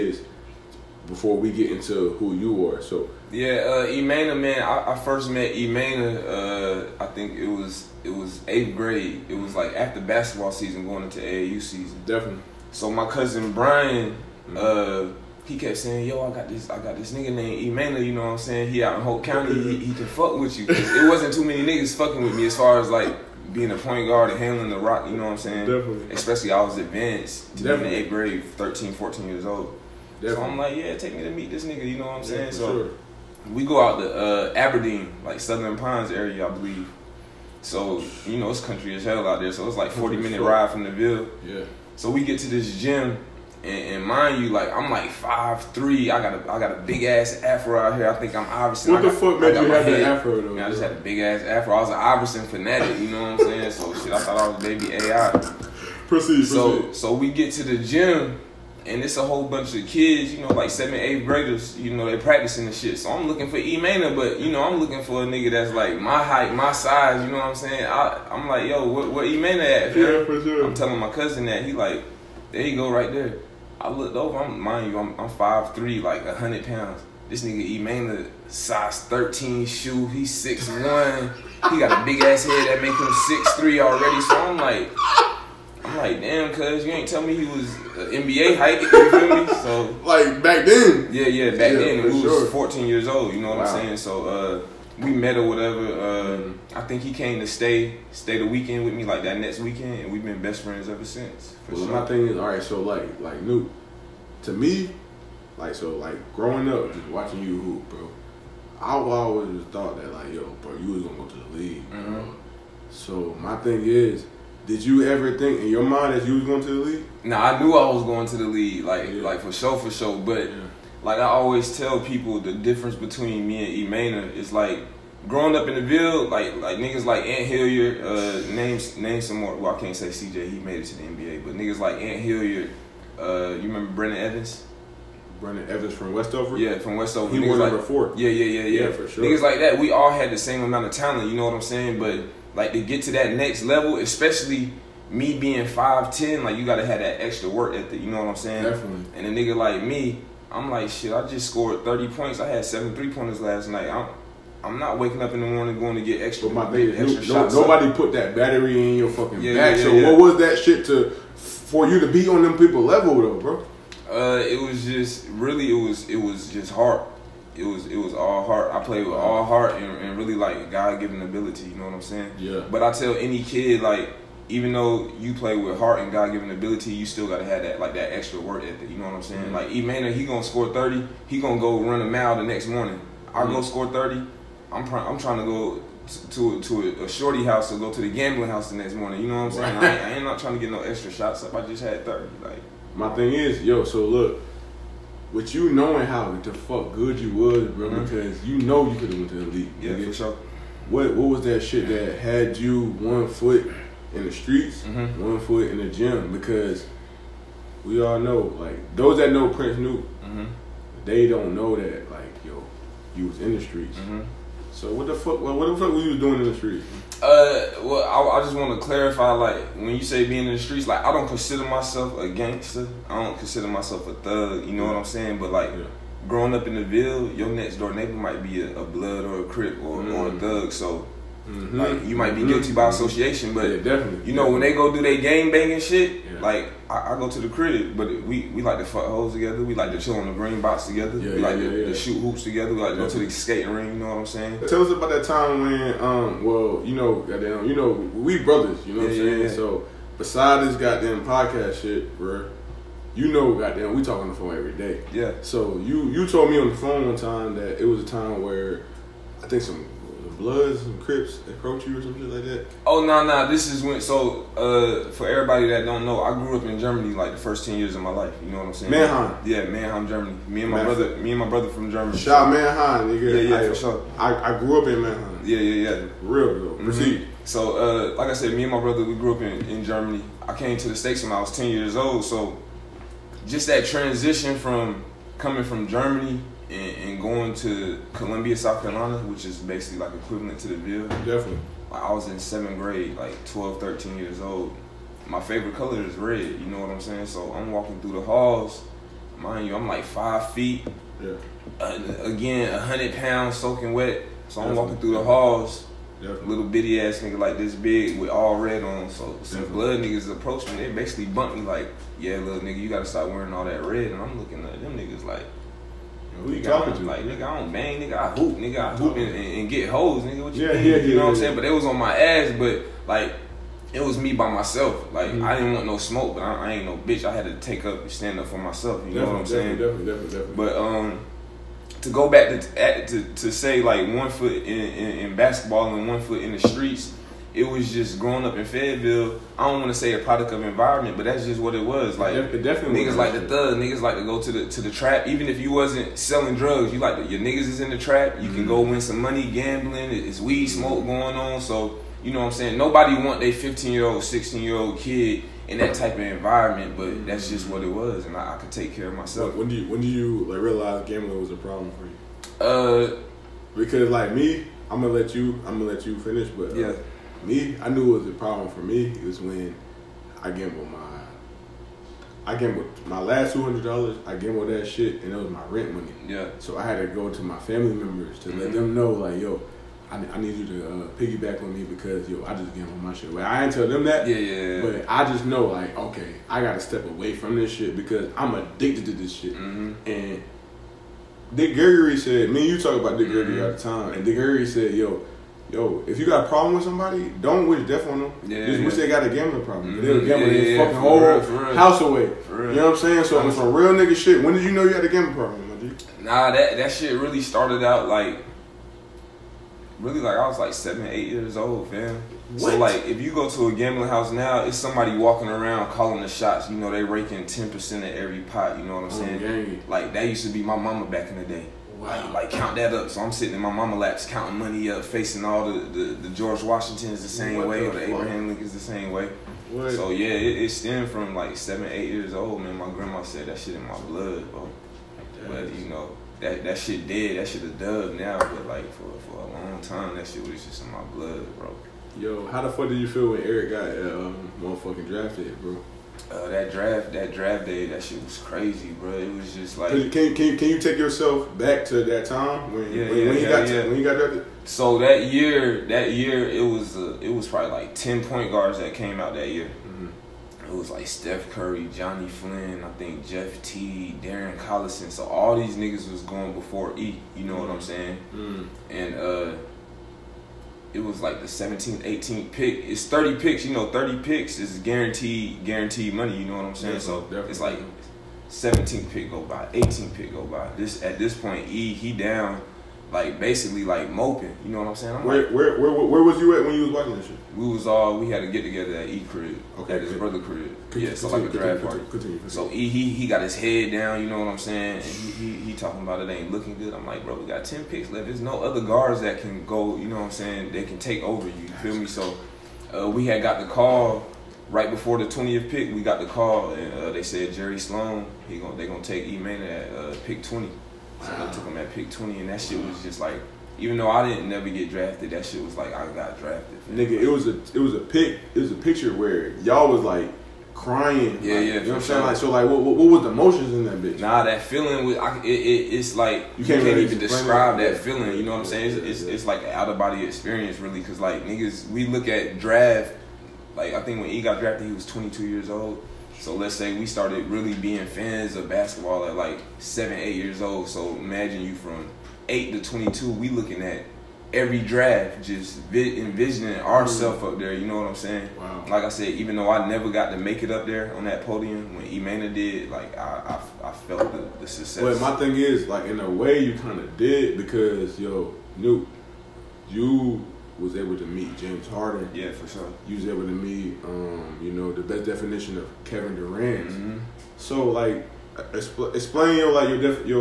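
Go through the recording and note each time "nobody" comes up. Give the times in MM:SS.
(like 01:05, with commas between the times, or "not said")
02:37, 05:52.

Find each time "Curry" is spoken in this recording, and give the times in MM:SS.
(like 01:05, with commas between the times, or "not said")
07:41.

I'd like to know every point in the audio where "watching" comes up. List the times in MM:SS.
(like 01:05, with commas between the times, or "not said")
01:47, 08:06.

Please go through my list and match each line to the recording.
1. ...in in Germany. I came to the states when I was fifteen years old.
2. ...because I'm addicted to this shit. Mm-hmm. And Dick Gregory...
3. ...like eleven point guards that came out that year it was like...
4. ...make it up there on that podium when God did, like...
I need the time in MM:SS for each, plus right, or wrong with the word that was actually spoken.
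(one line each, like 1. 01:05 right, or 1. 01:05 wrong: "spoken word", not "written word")
1. 04:39 wrong: "ten", not "fifteen"
2. 06:27 right
3. 07:37 wrong: "ten", not "eleven"
4. 09:10 wrong: "Emana", not "God".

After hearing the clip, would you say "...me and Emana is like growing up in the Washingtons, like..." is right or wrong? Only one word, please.
wrong.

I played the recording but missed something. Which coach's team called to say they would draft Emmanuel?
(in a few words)
Jerry Sloan.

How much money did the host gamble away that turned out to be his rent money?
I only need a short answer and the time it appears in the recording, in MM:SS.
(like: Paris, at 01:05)
$200, at 06:13.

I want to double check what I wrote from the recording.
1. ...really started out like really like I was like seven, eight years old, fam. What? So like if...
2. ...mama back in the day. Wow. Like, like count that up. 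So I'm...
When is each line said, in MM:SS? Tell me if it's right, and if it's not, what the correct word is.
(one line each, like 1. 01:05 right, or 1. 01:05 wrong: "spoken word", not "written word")
1. 06:47 right
2. 07:00 right.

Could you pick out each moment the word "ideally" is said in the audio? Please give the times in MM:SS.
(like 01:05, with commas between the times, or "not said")
not said.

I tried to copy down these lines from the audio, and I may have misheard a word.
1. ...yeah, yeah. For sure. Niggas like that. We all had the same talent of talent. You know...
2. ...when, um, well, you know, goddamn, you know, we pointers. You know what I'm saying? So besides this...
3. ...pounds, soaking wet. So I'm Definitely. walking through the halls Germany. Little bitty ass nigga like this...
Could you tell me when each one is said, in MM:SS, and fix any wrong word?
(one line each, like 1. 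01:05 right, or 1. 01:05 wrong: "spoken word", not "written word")
1. 02:18 wrong: "amount", not "talent"
2. 04:05 wrong: "brothers", not "pointers"
3. 05:03 wrong: "Definitely", not "Germany".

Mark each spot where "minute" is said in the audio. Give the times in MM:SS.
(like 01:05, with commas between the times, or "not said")
00:40.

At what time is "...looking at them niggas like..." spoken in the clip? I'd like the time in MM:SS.
05:14.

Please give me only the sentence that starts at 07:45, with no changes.
So all these niggas was going before E.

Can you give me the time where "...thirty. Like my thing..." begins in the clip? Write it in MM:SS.
03:12.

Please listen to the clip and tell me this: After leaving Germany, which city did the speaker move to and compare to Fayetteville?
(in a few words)
Columbia, South Carolina.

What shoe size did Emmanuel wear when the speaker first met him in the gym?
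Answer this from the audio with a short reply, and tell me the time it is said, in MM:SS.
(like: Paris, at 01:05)
13, at 01:18.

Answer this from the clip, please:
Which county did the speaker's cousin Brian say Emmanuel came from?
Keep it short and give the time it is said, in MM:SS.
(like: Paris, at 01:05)
Hoke County, at 00:19.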